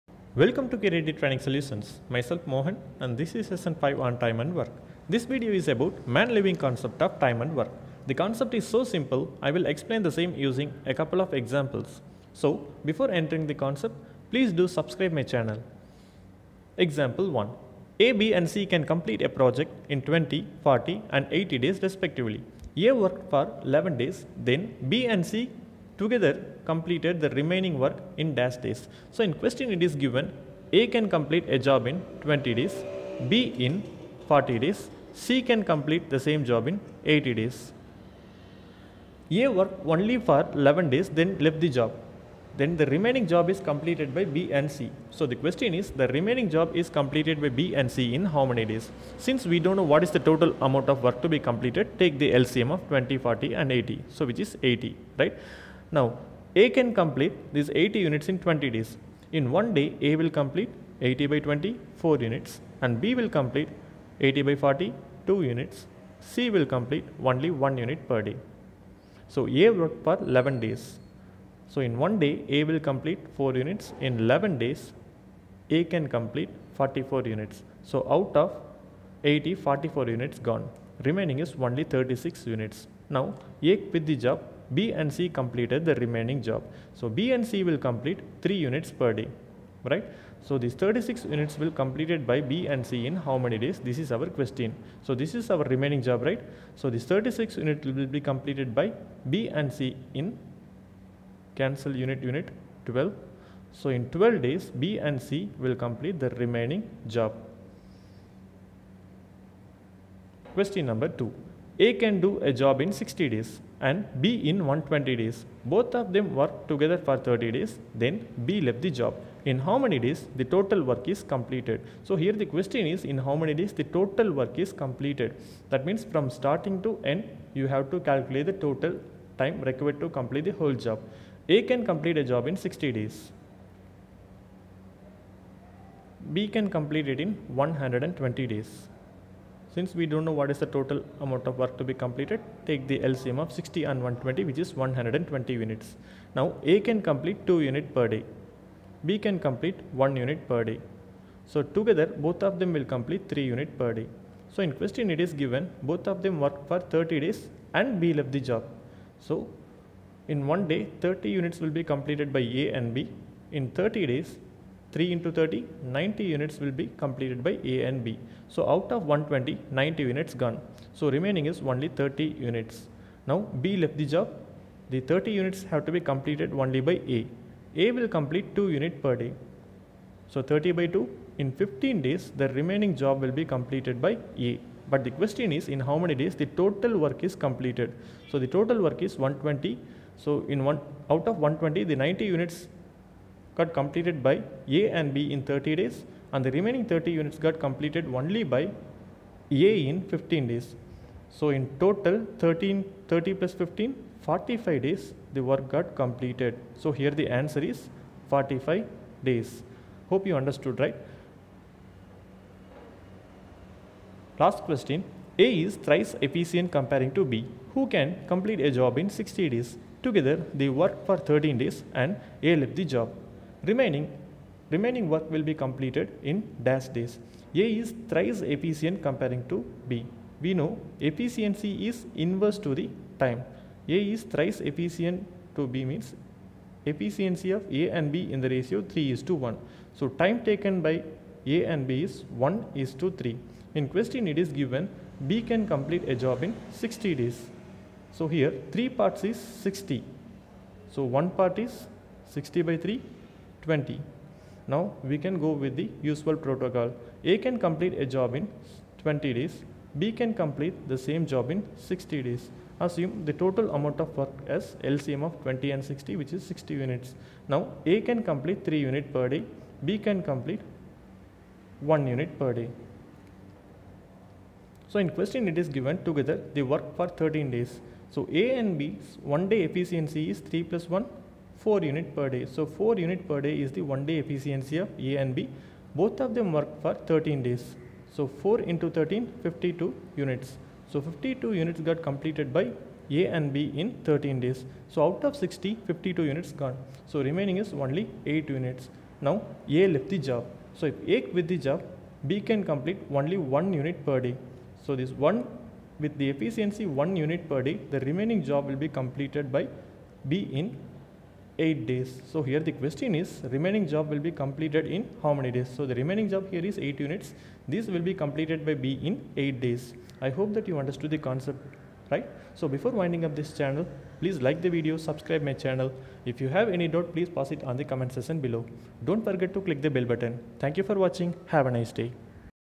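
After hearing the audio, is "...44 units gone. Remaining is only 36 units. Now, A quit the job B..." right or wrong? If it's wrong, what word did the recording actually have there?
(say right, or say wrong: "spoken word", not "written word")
right.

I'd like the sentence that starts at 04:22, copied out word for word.
Assume the total amount of work as LCM of 20 and 60 which is 60 units.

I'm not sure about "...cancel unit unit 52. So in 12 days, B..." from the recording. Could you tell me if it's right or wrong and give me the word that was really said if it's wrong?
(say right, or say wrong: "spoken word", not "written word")
wrong: "12", not "52".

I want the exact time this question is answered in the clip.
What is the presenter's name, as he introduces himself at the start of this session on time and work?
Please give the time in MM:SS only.
00:02.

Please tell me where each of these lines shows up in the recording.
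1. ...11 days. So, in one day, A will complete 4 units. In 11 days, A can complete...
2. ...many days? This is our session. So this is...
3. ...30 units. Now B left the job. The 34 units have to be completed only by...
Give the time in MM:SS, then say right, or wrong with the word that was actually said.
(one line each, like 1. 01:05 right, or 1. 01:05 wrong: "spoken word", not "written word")
1. 01:10 right
2. 01:33 wrong: "question", not "session"
3. 02:51 wrong: "30", not "34".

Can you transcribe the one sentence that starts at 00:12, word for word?
So, before entering the concept, please do subscribe my channel.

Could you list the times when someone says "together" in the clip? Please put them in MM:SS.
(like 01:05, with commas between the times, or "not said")
00:26, 01:56, 02:31, 03:40, 04:36.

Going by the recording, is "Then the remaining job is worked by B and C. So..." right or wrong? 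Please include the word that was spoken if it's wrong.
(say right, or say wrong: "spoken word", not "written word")
wrong: "completed", not "worked".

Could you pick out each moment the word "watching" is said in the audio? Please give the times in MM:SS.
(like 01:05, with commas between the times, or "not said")
05:31.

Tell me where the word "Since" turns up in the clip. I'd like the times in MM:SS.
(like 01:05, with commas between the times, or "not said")
00:49, 02:19.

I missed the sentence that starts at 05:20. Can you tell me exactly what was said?
I hope that you understood the concept, right?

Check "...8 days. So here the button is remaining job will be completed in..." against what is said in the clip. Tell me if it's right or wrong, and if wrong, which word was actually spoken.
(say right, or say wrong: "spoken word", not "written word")
wrong: "question", not "button".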